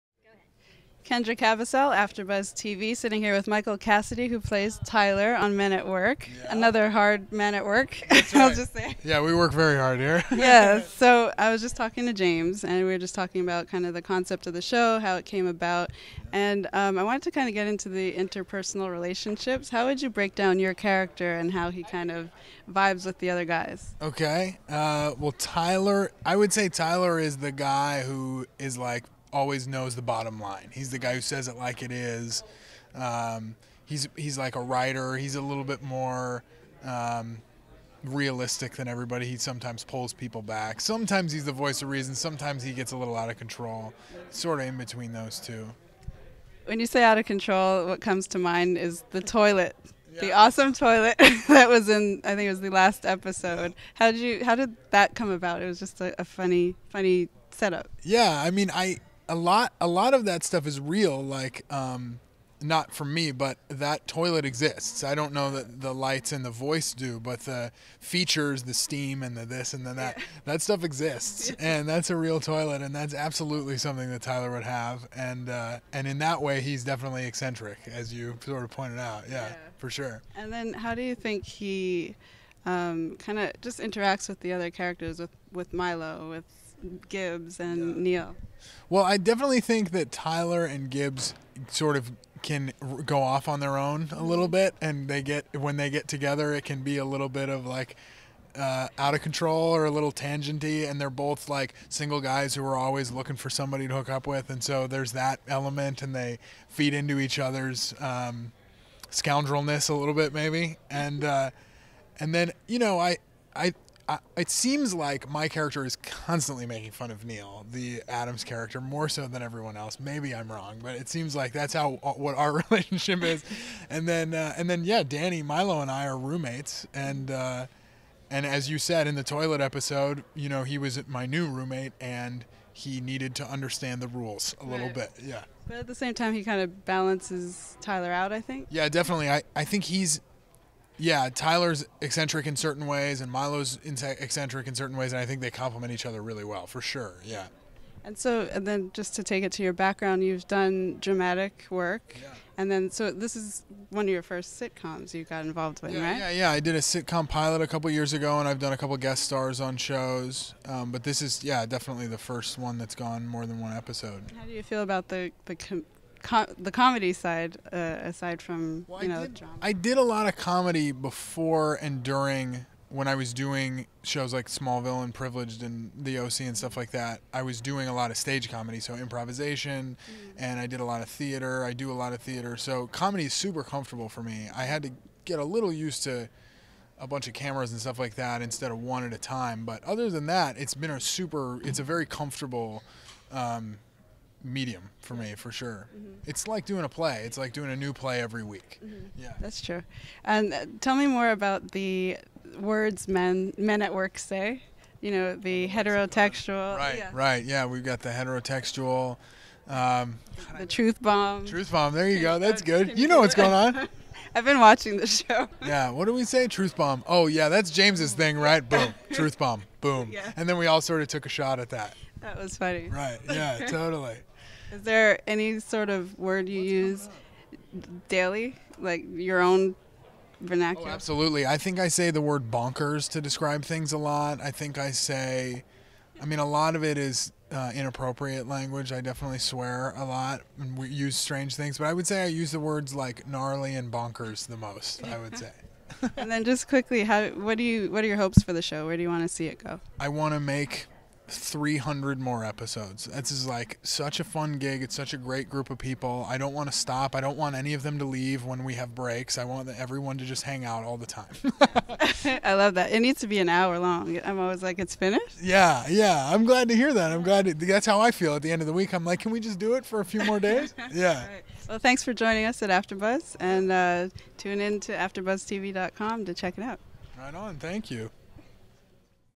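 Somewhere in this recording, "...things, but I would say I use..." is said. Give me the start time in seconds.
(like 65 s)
241 s.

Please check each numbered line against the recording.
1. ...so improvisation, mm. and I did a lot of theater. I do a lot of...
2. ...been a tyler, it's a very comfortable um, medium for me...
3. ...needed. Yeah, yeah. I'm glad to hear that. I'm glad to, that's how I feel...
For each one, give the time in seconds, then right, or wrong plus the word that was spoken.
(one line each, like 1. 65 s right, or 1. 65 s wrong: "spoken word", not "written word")
1. 178 s right
2. 190 s wrong: "super", not "tyler"
3. 264 s wrong: "finished", not "needed".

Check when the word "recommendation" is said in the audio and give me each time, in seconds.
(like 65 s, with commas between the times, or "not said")
not said.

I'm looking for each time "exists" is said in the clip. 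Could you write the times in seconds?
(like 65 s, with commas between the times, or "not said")
64 s, 70 s.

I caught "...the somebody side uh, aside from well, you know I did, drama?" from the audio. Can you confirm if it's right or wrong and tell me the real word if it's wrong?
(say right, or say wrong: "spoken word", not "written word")
wrong: "comedy", not "somebody".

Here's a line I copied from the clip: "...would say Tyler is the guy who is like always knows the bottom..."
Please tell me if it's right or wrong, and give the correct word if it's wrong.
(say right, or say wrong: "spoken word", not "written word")
right.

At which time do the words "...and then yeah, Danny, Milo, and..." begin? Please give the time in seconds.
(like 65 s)
124 s.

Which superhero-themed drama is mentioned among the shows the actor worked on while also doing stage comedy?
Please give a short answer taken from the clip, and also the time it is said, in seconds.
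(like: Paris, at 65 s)
Smallville, at 174 s.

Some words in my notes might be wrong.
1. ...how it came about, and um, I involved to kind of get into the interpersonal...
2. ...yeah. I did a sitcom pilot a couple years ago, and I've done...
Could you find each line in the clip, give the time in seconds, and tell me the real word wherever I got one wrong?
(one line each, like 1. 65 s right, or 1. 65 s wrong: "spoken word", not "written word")
1. 14 s wrong: "wanted", not "involved"
2. 156 s right.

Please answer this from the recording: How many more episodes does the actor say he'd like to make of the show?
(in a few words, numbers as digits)
300.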